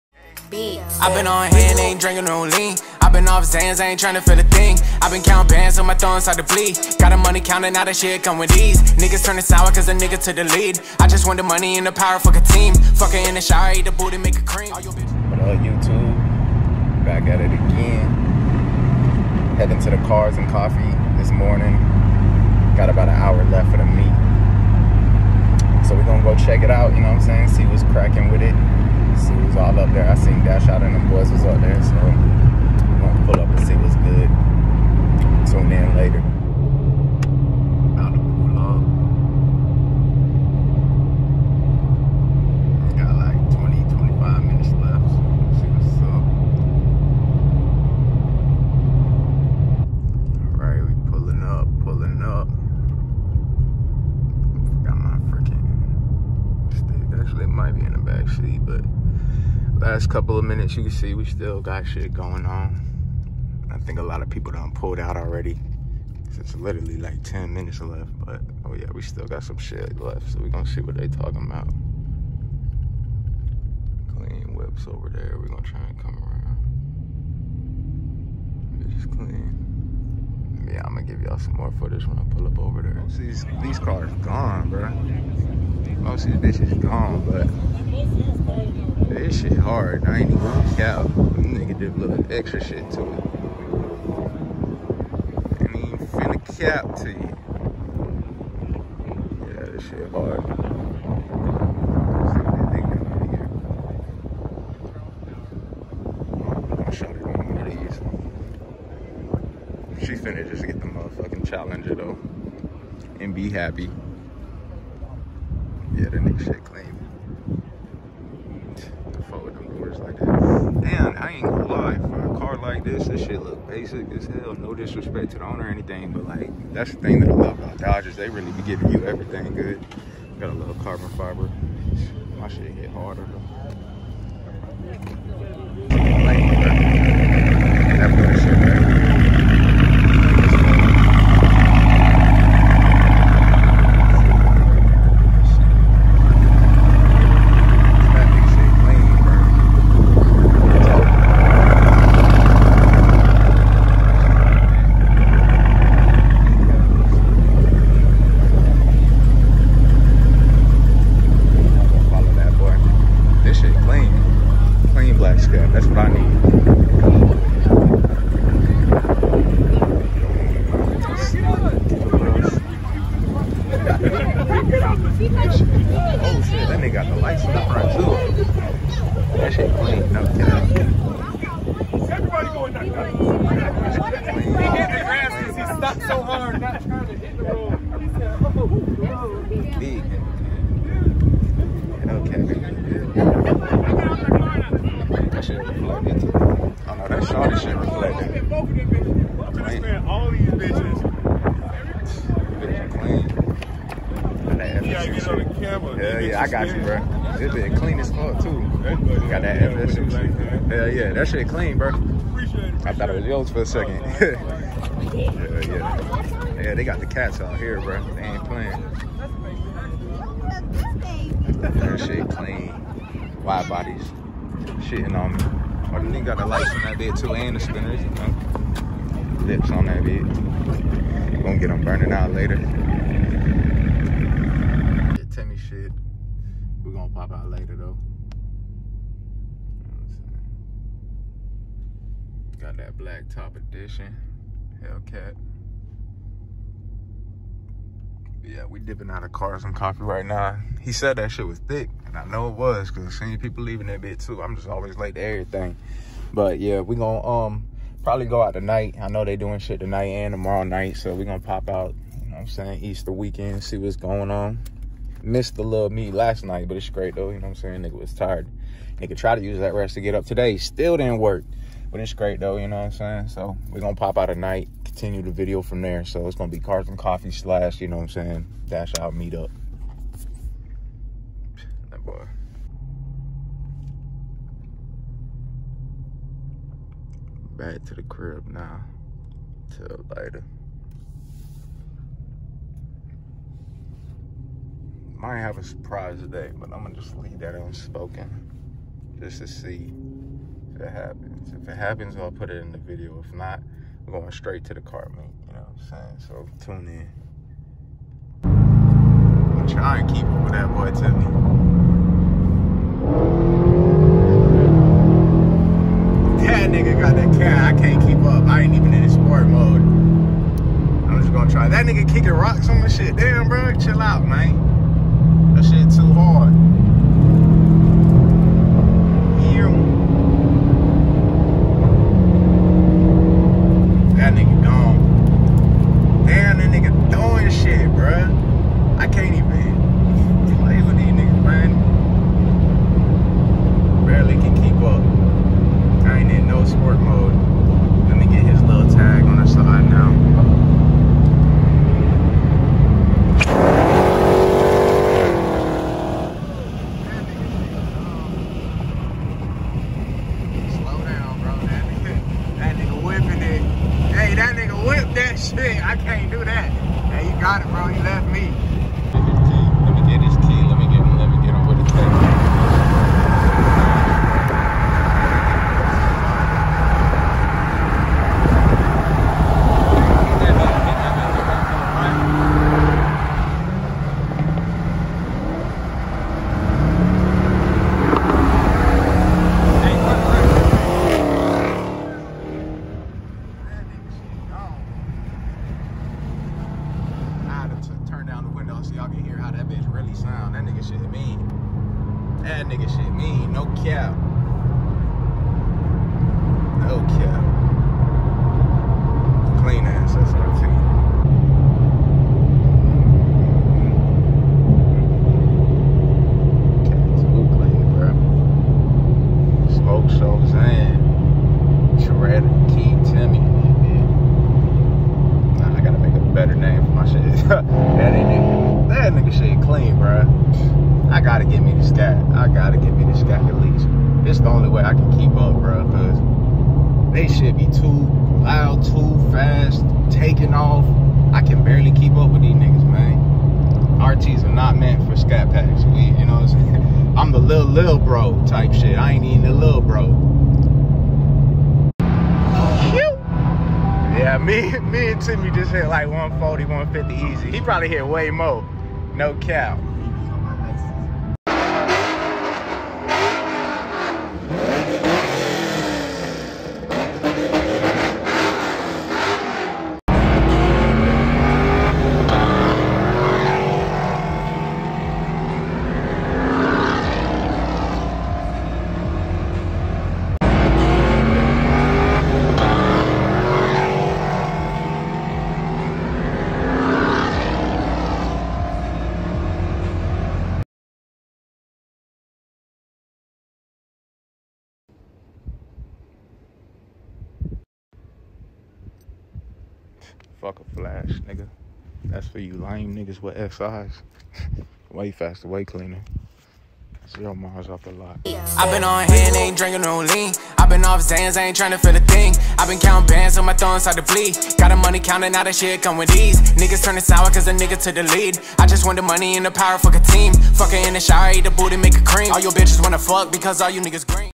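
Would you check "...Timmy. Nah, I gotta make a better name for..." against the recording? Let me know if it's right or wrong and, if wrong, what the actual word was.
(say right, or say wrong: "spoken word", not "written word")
right.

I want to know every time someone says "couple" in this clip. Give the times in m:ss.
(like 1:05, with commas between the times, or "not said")
1:00.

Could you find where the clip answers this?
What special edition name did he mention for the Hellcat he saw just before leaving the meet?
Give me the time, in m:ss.
4:02.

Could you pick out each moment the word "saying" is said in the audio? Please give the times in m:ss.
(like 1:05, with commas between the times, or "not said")
0:27, 4:22, 4:27, 4:32, 4:38, 5:05, 7:26.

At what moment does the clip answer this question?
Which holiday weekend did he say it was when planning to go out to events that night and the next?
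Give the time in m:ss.
4:22.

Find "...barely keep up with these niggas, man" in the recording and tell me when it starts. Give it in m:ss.
7:21.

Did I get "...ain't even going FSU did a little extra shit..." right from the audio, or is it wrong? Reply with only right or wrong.
wrong.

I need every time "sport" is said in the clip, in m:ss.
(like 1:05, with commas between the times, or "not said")
5:19, 5:46.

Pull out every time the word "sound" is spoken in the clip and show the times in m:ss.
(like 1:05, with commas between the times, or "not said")
6:40.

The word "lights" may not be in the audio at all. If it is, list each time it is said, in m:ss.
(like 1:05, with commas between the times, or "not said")
2:57, 3:46.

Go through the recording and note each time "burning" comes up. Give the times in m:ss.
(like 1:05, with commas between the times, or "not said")
3:51.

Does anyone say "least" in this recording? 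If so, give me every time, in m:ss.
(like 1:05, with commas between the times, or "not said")
7:13.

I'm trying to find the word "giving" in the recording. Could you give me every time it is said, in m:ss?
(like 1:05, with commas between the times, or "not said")
2:08.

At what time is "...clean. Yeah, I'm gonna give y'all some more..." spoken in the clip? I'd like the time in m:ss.
1:19.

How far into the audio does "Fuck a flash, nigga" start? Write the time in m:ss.
8:20.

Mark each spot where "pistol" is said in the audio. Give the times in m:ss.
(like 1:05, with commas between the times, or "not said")
not said.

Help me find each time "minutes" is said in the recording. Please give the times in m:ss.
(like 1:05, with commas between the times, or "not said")
1:00, 1:07.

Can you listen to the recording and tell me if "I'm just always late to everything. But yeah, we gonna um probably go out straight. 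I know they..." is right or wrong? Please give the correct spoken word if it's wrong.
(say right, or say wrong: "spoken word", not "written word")
wrong: "tonight", not "straight".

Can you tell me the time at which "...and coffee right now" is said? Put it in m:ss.
4:09.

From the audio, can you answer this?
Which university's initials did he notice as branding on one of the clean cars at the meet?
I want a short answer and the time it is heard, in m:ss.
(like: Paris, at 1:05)
FSU, at 3:29.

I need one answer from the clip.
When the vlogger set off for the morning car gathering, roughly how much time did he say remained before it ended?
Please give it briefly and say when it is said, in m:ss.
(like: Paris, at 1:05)
about an hour, at 0:22.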